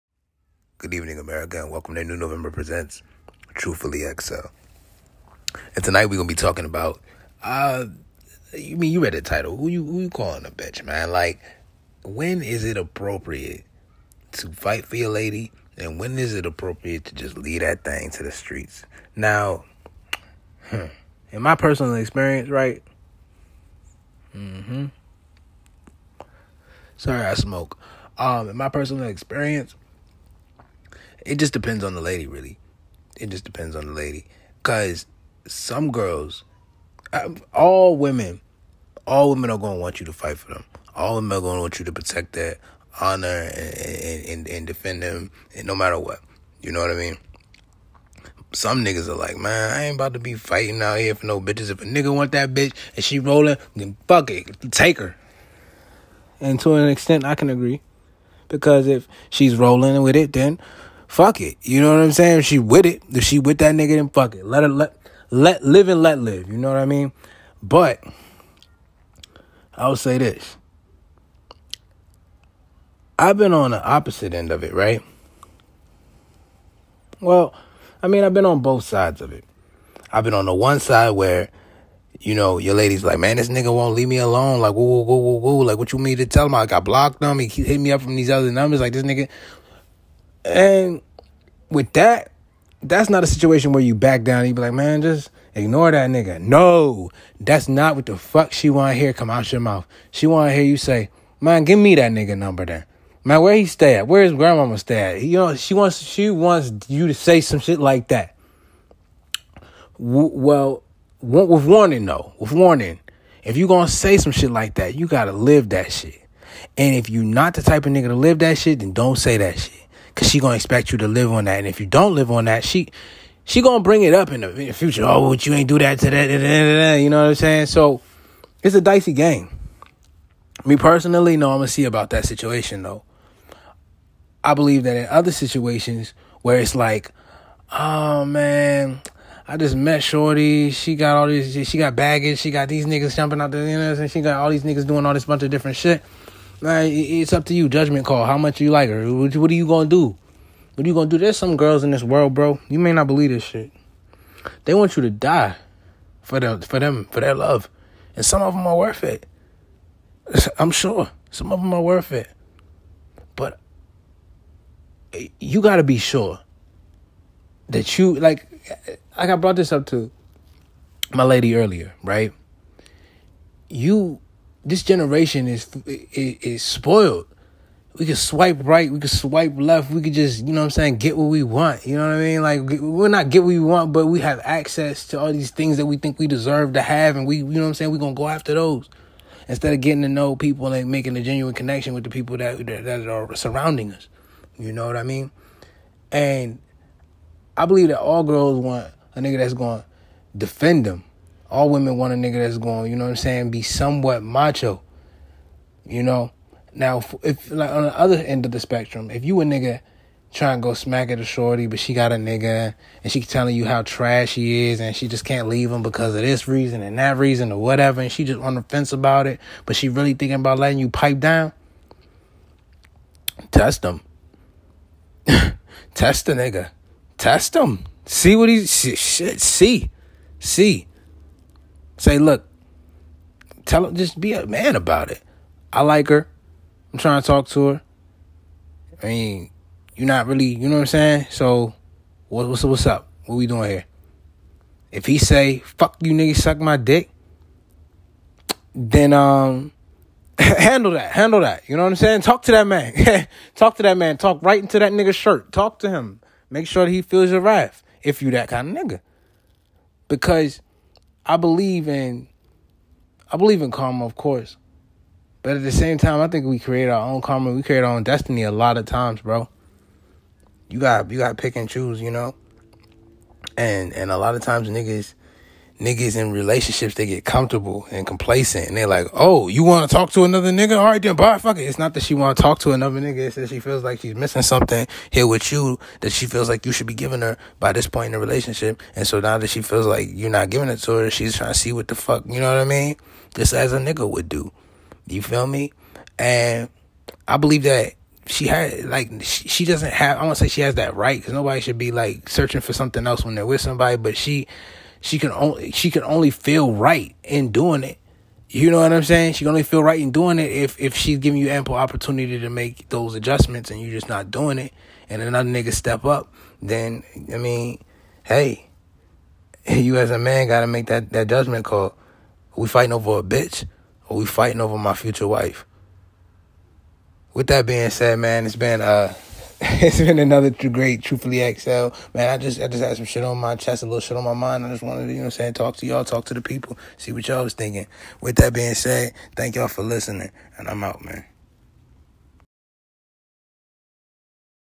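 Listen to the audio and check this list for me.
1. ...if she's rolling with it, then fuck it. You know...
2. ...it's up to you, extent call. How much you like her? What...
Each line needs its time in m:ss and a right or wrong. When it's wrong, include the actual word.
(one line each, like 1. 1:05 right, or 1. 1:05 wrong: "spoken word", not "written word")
1. 0:58 right
2. 2:26 wrong: "judgment", not "extent".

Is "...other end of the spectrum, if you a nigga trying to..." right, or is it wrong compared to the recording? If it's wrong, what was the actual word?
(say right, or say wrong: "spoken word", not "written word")
right.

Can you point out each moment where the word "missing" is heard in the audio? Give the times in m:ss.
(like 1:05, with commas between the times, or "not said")
4:44.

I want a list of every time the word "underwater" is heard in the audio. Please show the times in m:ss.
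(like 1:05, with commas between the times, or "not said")
not said.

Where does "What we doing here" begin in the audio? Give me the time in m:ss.
4:03.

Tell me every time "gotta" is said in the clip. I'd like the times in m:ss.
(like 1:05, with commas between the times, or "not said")
1:55, 2:45.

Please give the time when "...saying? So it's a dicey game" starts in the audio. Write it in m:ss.
2:07.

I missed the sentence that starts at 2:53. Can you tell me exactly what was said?
You this generation is, is is, spoiled.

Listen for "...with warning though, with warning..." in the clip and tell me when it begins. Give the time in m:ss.
1:51.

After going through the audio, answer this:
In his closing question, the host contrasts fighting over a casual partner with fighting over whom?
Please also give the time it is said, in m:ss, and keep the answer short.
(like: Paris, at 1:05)
my future wife, at 5:24.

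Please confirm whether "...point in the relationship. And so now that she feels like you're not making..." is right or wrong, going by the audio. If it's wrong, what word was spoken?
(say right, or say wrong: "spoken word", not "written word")
wrong: "giving", not "making".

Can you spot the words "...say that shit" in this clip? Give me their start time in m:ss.
1:59.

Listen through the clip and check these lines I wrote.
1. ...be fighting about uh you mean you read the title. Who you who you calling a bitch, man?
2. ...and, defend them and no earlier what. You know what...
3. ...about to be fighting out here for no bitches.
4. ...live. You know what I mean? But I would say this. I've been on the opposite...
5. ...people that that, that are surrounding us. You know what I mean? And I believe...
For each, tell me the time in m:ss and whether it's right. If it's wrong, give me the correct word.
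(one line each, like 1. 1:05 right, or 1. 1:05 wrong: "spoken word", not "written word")
1. 0:06 wrong: "talking", not "fighting"
2. 0:44 wrong: "matter", not "earlier"
3. 0:49 right
4. 1:06 right
5. 3:12 right.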